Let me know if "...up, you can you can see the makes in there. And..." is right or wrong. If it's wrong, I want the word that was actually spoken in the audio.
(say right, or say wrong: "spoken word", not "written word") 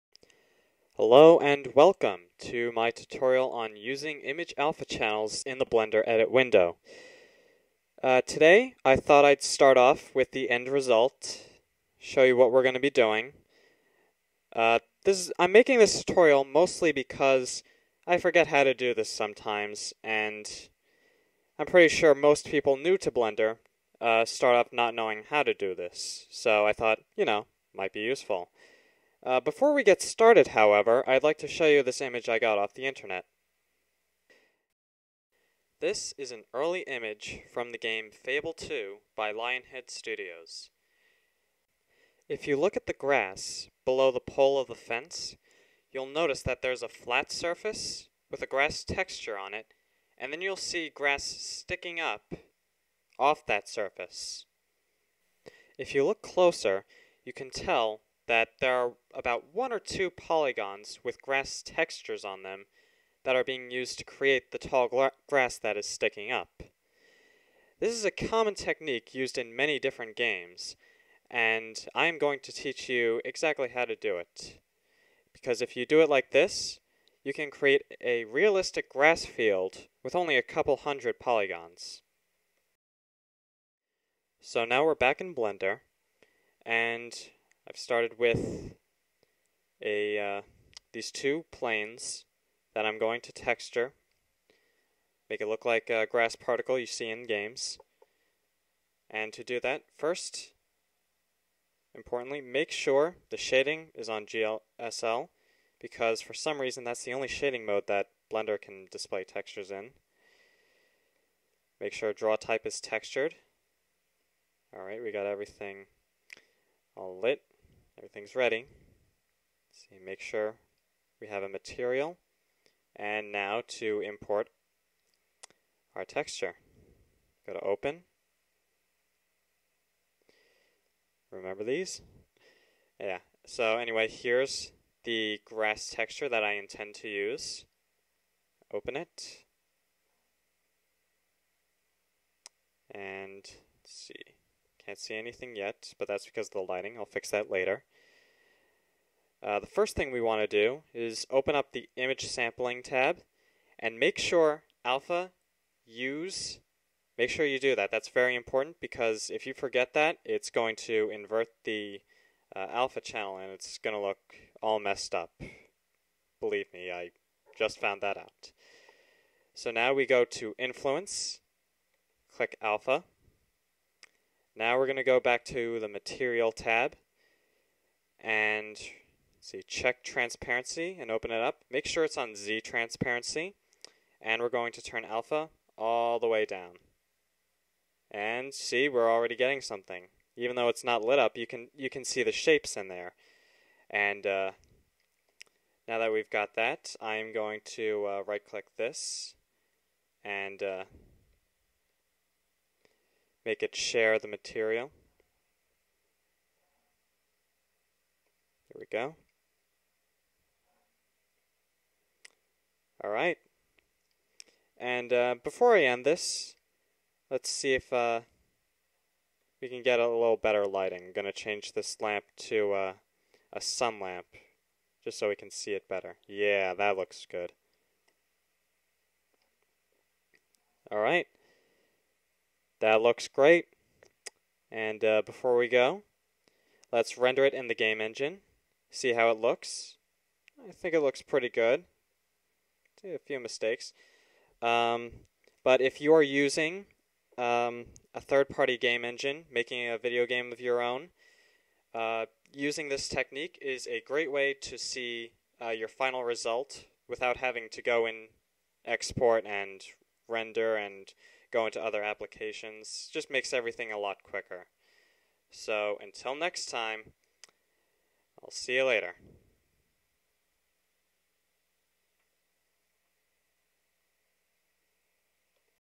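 wrong: "shapes", not "makes".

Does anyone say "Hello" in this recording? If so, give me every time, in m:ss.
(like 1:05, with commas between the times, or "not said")
0:01.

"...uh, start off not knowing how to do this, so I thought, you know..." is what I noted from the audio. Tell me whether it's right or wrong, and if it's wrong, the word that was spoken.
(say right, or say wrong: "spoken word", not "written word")
right.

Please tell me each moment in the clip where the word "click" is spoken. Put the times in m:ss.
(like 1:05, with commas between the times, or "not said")
2:52, 3:18.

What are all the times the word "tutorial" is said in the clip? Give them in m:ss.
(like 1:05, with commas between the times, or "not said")
0:02, 0:16.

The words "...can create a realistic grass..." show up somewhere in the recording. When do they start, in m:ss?
1:17.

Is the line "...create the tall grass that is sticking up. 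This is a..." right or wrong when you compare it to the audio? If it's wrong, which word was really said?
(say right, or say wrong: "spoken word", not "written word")
right.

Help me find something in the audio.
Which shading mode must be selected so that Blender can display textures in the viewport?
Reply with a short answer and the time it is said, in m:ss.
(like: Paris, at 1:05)
GLSL, at 1:44.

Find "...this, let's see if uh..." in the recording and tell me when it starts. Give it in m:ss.
3:36.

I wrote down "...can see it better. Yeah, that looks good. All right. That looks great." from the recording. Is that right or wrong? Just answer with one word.
right.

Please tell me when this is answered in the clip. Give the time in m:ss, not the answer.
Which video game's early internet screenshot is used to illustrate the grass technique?
0:38.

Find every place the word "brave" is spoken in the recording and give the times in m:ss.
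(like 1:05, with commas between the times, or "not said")
not said.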